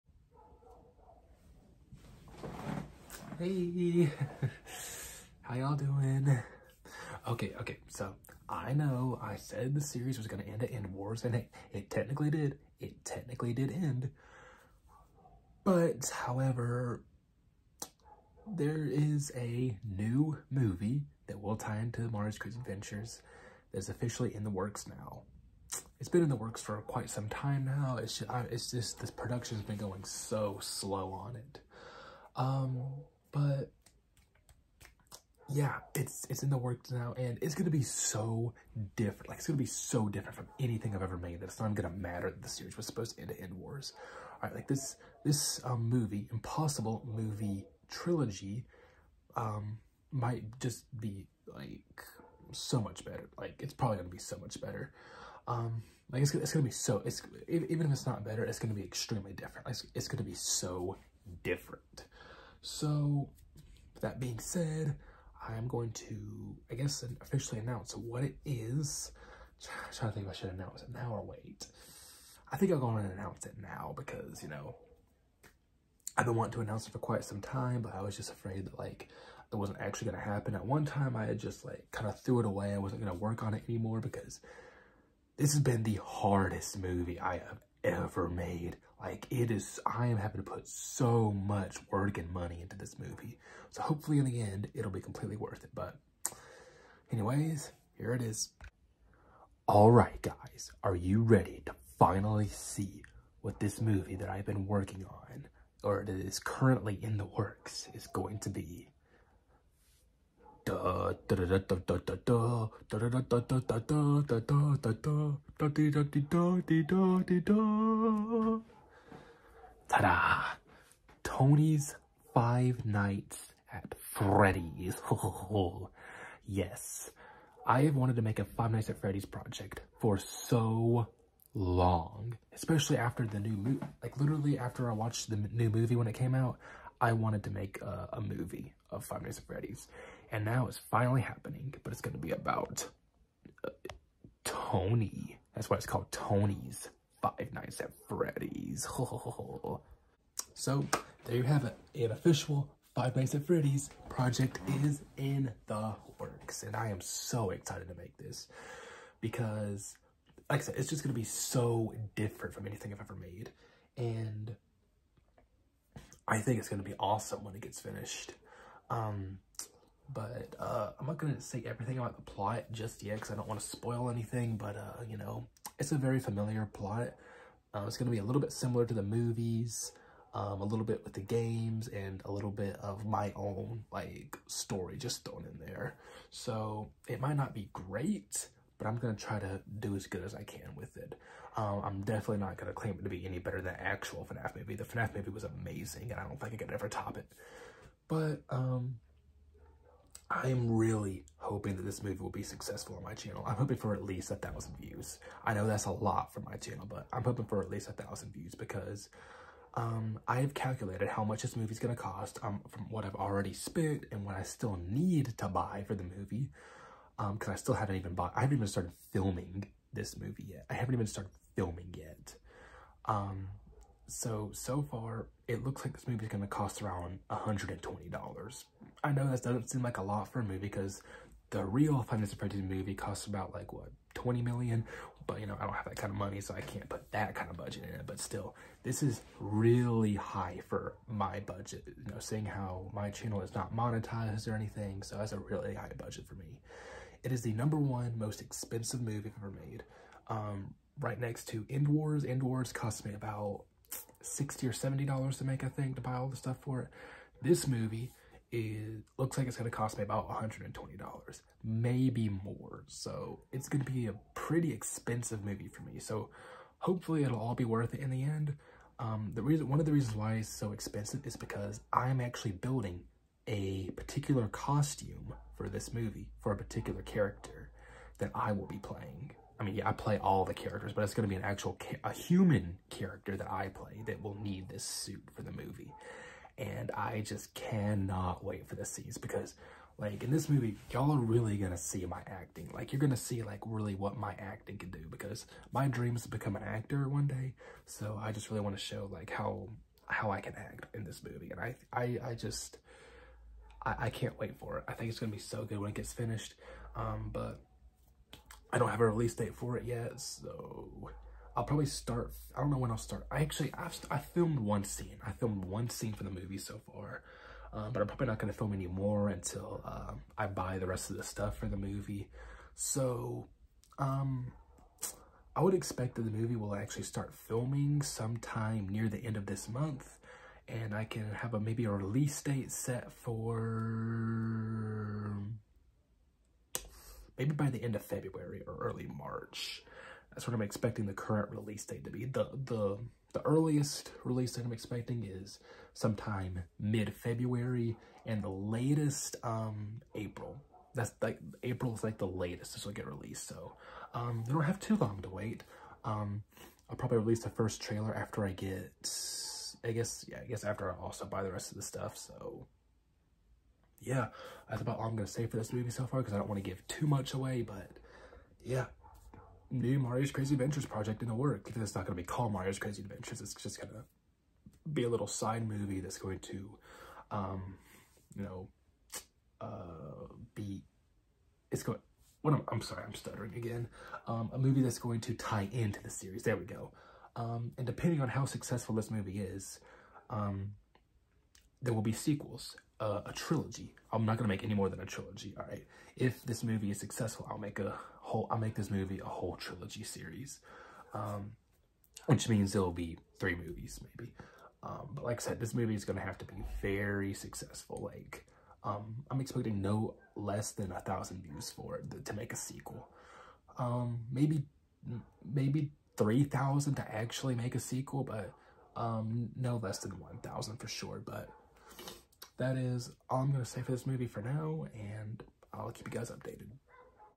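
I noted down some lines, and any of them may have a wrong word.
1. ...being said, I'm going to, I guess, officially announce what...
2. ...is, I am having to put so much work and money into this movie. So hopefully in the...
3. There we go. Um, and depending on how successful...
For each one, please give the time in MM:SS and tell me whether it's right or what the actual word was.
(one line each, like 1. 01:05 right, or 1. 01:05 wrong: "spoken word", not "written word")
1. 01:04 right
2. 01:29 right
3. 06:26 right.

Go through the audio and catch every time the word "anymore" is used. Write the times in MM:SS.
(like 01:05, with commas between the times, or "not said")
01:23.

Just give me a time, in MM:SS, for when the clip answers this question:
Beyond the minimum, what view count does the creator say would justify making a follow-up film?
06:56.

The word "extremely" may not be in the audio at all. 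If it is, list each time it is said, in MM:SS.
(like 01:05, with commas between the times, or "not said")
00:58.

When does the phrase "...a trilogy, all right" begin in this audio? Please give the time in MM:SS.
06:34.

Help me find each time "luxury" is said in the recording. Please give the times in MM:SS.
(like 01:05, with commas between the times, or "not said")
not said.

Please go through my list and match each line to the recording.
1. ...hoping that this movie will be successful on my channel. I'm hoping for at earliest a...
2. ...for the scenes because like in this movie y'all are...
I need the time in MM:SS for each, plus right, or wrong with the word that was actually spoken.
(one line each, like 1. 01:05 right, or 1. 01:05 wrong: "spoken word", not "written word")
1. 03:21 wrong: "least", not "earliest"
2. 04:48 right.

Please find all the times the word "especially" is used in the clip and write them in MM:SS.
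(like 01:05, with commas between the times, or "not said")
02:12.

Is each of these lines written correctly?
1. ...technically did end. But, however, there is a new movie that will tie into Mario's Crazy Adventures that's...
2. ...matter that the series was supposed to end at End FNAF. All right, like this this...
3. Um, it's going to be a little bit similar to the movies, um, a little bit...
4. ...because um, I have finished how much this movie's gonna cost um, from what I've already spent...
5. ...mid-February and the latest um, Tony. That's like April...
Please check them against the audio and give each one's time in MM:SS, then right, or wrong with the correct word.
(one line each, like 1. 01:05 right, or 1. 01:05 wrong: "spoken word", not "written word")
1. 00:13 right
2. 00:41 wrong: "Wars", not "FNAF"
3. 02:57 right
4. 03:28 wrong: "calculated", not "finished"
5. 05:46 wrong: "April", not "Tony".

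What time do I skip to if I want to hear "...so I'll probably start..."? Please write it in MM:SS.
05:10.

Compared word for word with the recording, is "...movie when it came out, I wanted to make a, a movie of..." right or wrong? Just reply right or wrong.
right.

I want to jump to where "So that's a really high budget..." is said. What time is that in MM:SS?
04:05.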